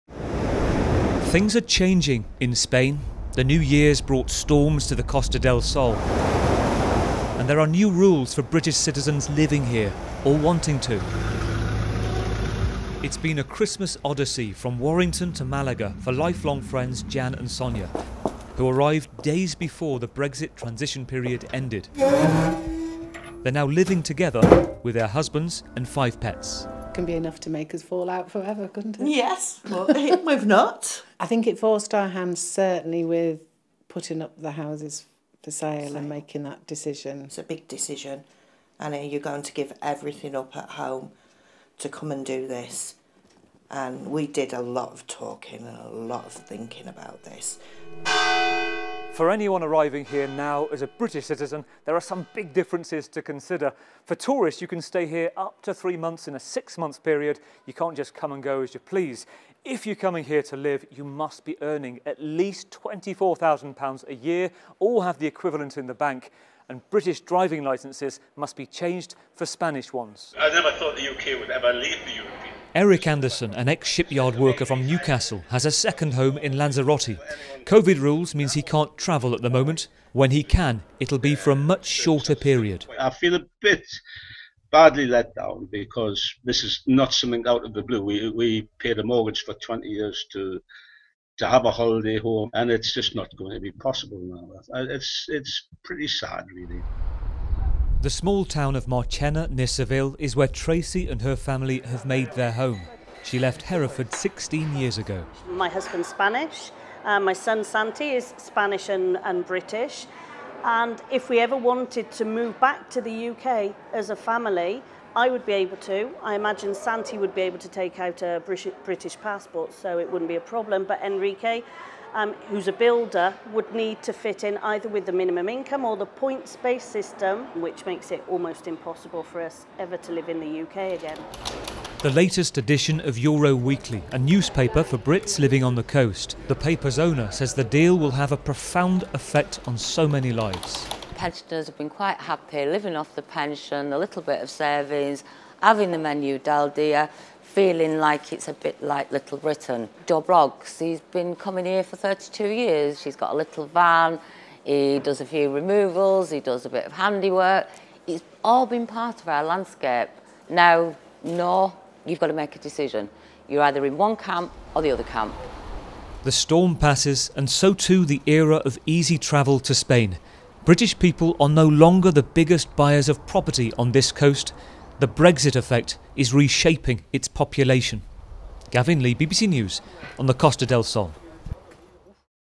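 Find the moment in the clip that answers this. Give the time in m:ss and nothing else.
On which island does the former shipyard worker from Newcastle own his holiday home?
1:16.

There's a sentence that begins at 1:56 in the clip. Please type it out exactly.
I imagine Santi would be able to take out a British passport, so it wouldn't be a problem.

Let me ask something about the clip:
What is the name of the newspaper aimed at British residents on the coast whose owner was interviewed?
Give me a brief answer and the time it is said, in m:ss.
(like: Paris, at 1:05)
Euro Weekly, at 2:13.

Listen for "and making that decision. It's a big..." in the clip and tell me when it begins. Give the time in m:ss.
0:35.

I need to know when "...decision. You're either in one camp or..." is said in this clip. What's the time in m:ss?
2:42.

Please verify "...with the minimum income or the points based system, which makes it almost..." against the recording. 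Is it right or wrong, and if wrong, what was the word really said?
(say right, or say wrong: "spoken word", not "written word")
right.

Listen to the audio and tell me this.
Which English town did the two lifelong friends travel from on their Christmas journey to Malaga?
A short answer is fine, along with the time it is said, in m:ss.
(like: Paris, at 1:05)
Warrington, at 0:14.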